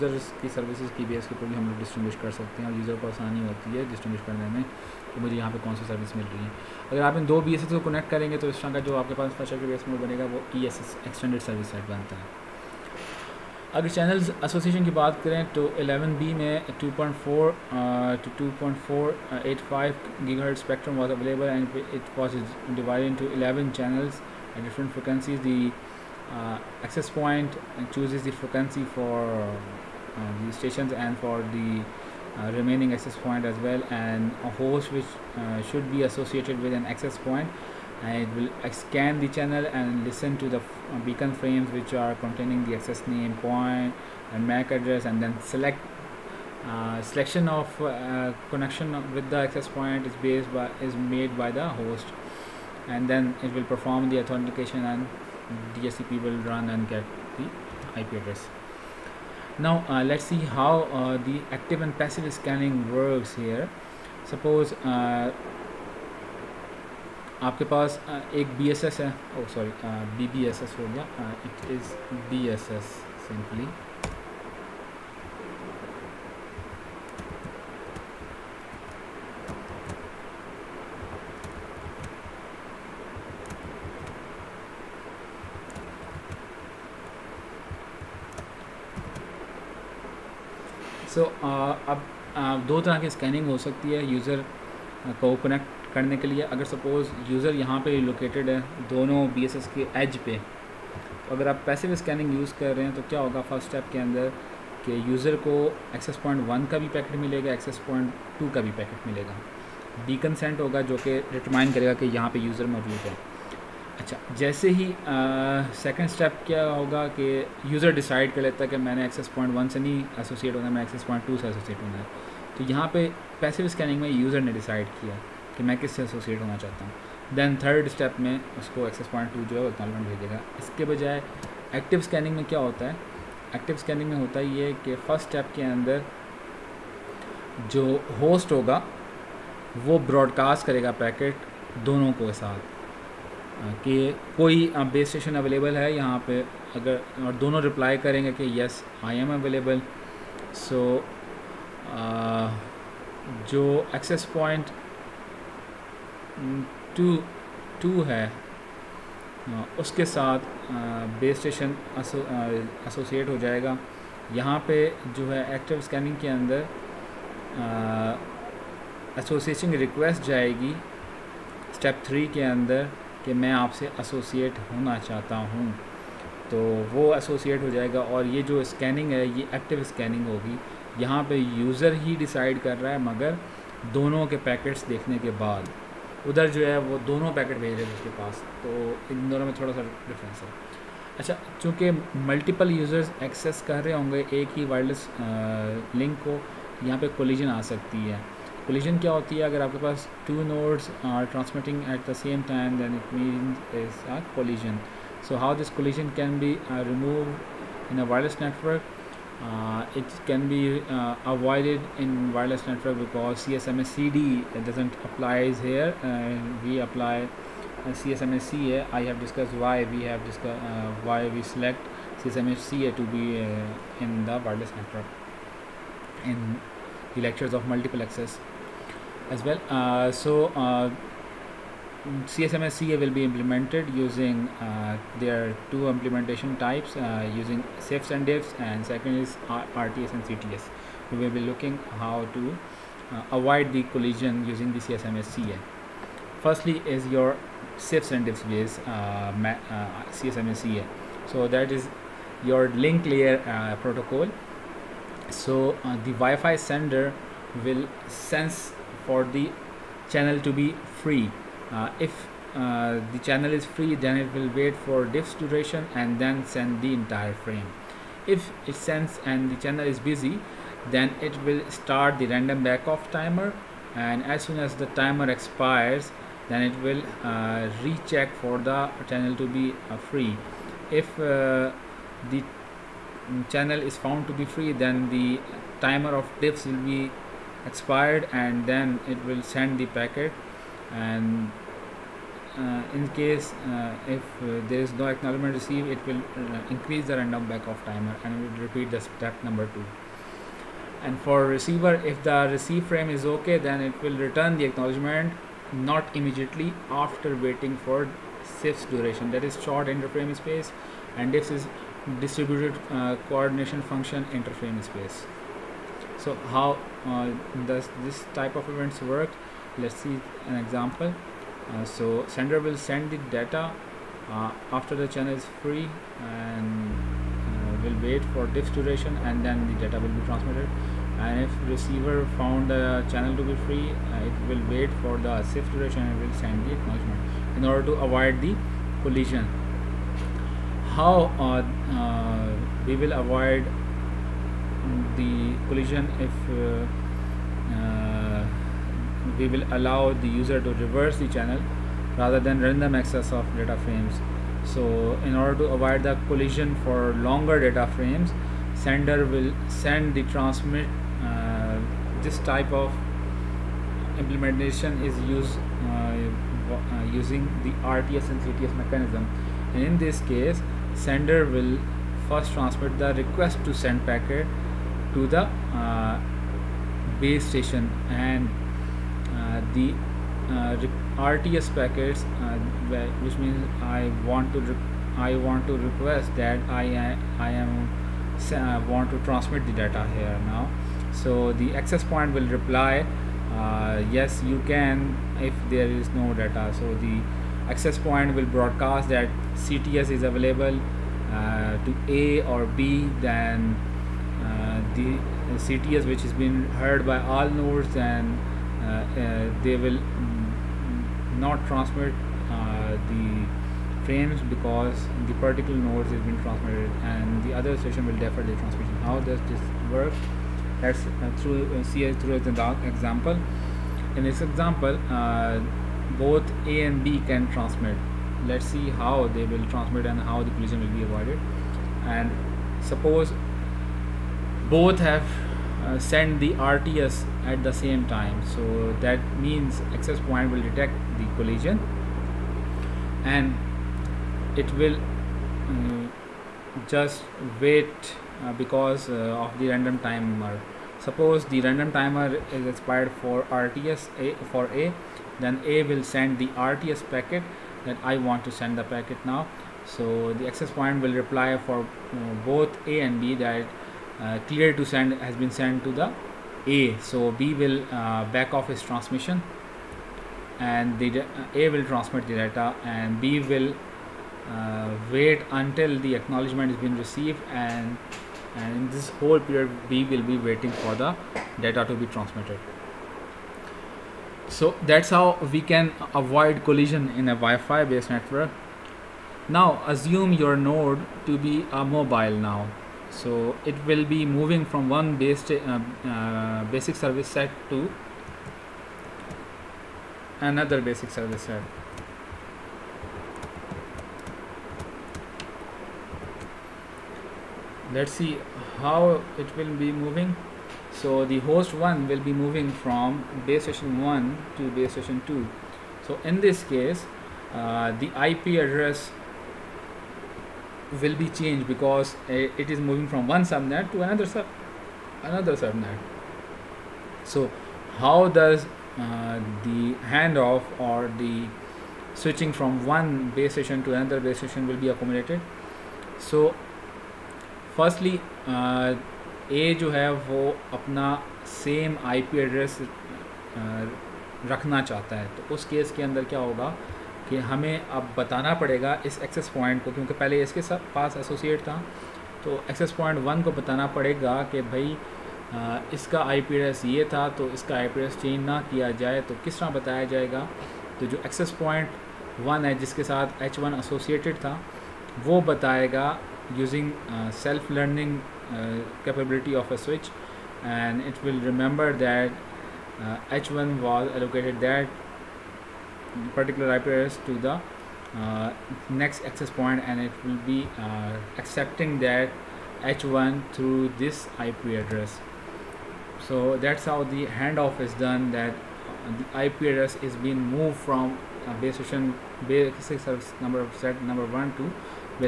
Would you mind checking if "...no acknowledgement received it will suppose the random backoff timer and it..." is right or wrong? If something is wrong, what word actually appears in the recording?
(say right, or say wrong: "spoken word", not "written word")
wrong: "increase", not "suppose".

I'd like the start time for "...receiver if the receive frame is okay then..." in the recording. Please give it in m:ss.
5:01.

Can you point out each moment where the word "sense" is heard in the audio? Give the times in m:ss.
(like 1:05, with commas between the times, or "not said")
4:18.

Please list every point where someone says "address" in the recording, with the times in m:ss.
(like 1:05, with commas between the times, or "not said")
0:44, 0:58, 8:38, 9:36, 9:44, 9:49.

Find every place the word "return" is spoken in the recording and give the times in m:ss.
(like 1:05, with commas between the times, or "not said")
5:04.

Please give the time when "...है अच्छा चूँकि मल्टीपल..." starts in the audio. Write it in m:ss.
3:10.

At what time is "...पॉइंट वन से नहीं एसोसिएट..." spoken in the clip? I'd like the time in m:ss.
1:59.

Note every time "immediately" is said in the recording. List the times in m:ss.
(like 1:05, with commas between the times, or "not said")
5:06.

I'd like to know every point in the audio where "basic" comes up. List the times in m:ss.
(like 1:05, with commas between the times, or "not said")
8:16, 8:20, 9:52.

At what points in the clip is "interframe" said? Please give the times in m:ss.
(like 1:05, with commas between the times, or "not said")
5:09, 5:14.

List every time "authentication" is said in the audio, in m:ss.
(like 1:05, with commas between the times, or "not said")
0:54.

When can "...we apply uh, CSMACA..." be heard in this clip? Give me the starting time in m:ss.
3:36.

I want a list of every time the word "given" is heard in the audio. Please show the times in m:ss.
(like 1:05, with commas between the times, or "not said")
not said.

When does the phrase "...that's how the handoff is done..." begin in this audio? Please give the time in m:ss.
9:46.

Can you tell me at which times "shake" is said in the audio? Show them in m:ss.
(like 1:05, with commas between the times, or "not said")
not said.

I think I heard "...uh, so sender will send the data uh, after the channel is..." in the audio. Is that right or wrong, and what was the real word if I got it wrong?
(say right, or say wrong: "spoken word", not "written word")
right.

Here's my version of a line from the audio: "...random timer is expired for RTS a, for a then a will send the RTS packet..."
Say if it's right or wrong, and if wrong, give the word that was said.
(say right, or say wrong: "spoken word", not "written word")
right.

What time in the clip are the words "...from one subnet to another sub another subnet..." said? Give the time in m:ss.
8:43.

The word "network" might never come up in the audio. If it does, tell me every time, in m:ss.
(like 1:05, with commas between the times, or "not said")
3:32, 3:44, 8:08.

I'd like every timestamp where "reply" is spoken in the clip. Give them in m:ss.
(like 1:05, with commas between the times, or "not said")
6:32, 7:41.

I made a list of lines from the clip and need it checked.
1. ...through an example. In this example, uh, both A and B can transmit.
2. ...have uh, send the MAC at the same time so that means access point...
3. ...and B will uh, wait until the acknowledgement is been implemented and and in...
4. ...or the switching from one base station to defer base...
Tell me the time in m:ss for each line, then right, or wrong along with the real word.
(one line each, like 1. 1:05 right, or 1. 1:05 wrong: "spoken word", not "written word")
1. 7:02 right
2. 7:15 wrong: "RTS", not "MAC"
3. 7:52 wrong: "received", not "implemented"
4. 8:50 wrong: "another", not "defer".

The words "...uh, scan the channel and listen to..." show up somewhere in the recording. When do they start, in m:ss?
0:38.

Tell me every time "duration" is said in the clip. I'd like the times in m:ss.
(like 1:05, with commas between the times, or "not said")
4:25, 5:08, 5:28, 5:35.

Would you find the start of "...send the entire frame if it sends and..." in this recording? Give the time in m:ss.
4:26.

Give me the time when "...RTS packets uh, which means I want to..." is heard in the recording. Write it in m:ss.
6:21.